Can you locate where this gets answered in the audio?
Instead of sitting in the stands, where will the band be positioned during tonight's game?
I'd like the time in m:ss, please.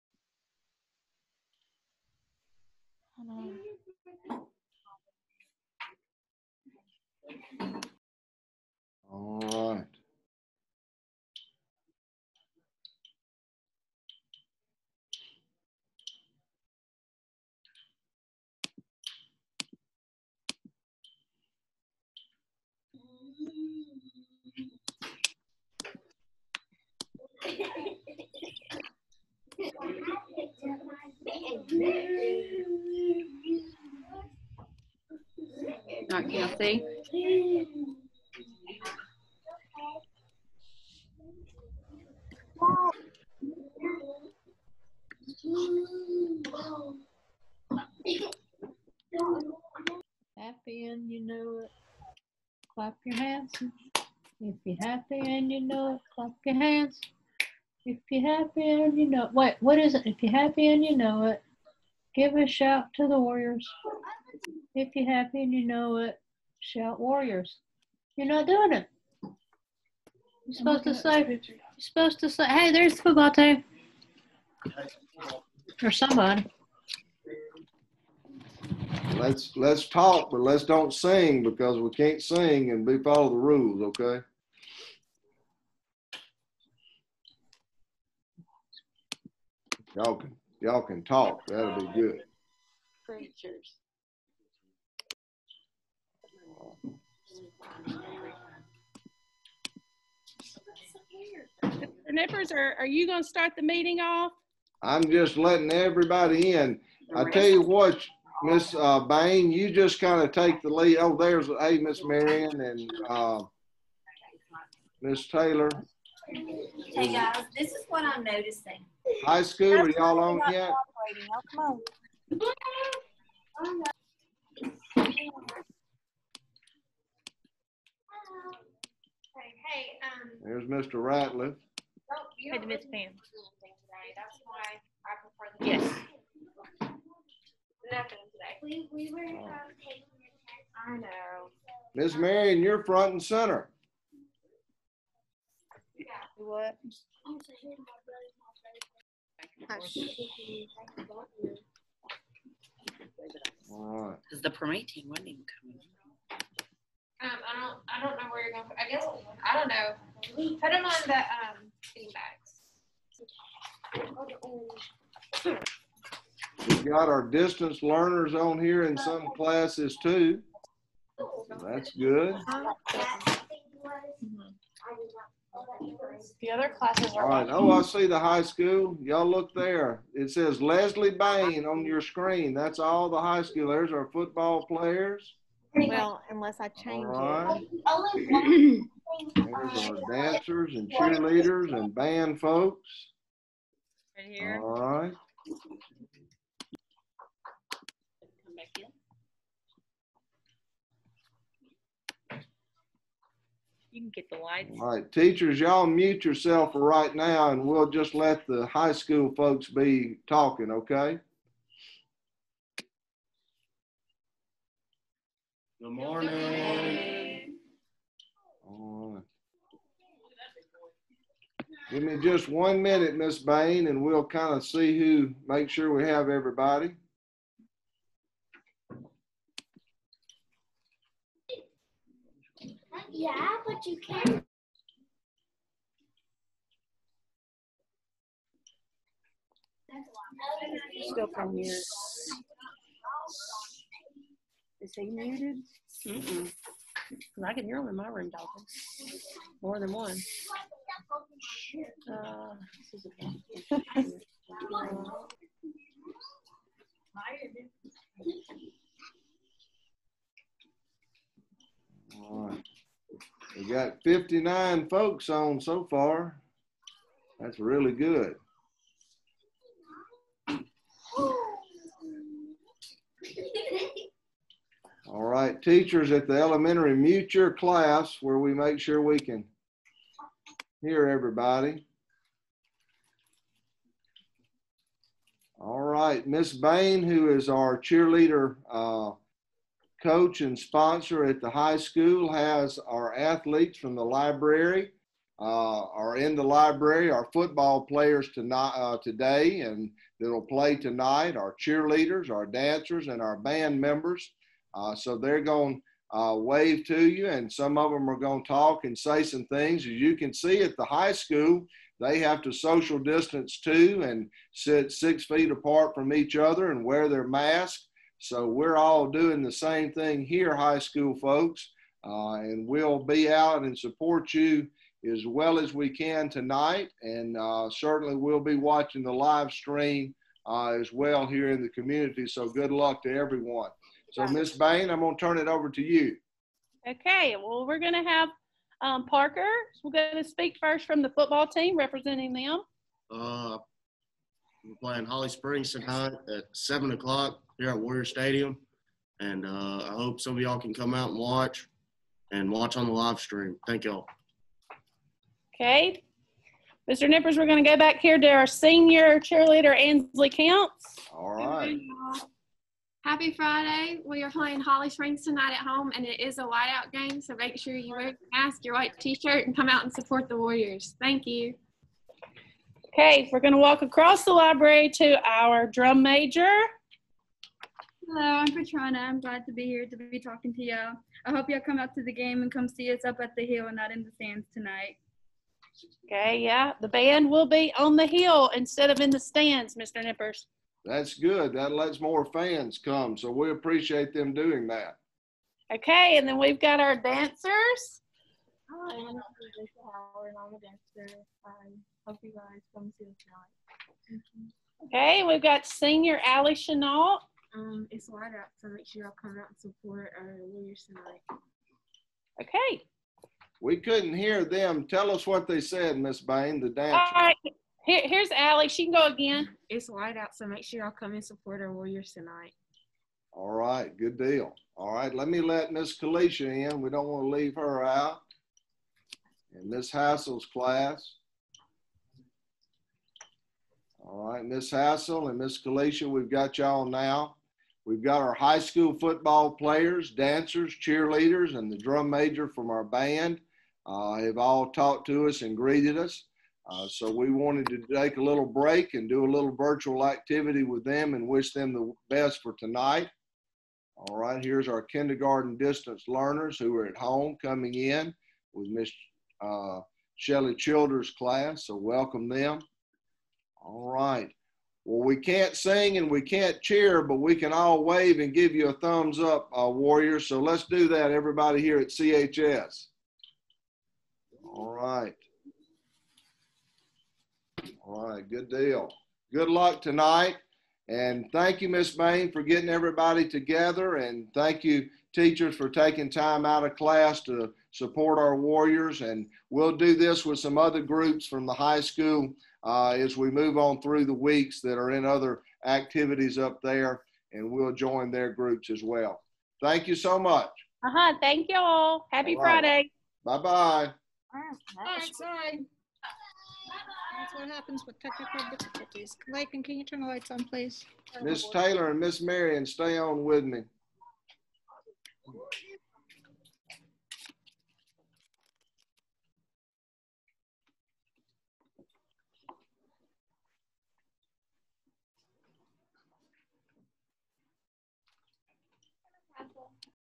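6:27.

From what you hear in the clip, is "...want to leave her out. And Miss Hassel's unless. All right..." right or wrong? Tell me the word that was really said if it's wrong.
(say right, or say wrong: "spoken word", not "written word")
wrong: "class", not "unless".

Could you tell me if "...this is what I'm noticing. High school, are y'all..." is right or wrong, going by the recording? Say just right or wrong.
right.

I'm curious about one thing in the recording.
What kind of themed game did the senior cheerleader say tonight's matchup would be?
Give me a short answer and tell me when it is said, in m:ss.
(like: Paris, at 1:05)
whiteout, at 6:06.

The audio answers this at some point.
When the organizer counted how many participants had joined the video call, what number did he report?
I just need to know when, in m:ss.
4:24.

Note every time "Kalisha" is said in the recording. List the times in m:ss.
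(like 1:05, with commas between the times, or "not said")
7:05, 7:15.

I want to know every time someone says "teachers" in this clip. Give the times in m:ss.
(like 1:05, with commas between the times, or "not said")
3:25, 4:35, 8:05.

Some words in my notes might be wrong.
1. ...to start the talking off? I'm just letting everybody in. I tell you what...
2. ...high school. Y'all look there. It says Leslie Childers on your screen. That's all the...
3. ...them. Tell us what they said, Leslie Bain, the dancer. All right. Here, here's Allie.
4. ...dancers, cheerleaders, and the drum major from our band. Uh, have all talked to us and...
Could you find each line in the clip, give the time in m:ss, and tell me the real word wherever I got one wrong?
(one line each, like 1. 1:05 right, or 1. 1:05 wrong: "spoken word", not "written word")
1. 1:43 wrong: "meeting", not "talking"
2. 2:58 wrong: "Bain", not "Childers"
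3. 6:54 wrong: "Miss", not "Leslie"
4. 7:20 right.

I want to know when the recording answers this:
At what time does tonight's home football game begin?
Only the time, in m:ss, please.
5:46.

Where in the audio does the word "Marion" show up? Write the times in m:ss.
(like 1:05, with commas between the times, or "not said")
1:52, 2:22, 8:32.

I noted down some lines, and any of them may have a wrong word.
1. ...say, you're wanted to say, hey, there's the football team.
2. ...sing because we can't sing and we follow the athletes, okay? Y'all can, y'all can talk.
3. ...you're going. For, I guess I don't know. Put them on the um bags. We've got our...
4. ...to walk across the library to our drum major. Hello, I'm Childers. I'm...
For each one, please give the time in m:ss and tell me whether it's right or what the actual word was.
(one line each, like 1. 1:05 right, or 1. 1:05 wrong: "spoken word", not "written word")
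1. 1:10 wrong: "supposed", not "wanted"
2. 1:20 wrong: "rules", not "athletes"
3. 2:38 right
4. 6:13 wrong: "Petrana", not "Childers".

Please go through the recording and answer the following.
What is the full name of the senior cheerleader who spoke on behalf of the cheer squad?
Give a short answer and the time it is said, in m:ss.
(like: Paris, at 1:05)
Ansley Counts, at 5:59.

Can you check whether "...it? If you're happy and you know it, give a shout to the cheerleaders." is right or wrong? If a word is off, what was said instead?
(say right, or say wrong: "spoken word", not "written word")
wrong: "warriors", not "cheerleaders".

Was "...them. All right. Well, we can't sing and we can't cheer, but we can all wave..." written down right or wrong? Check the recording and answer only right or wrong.
right.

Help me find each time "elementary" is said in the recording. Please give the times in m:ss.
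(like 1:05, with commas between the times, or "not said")
4:36.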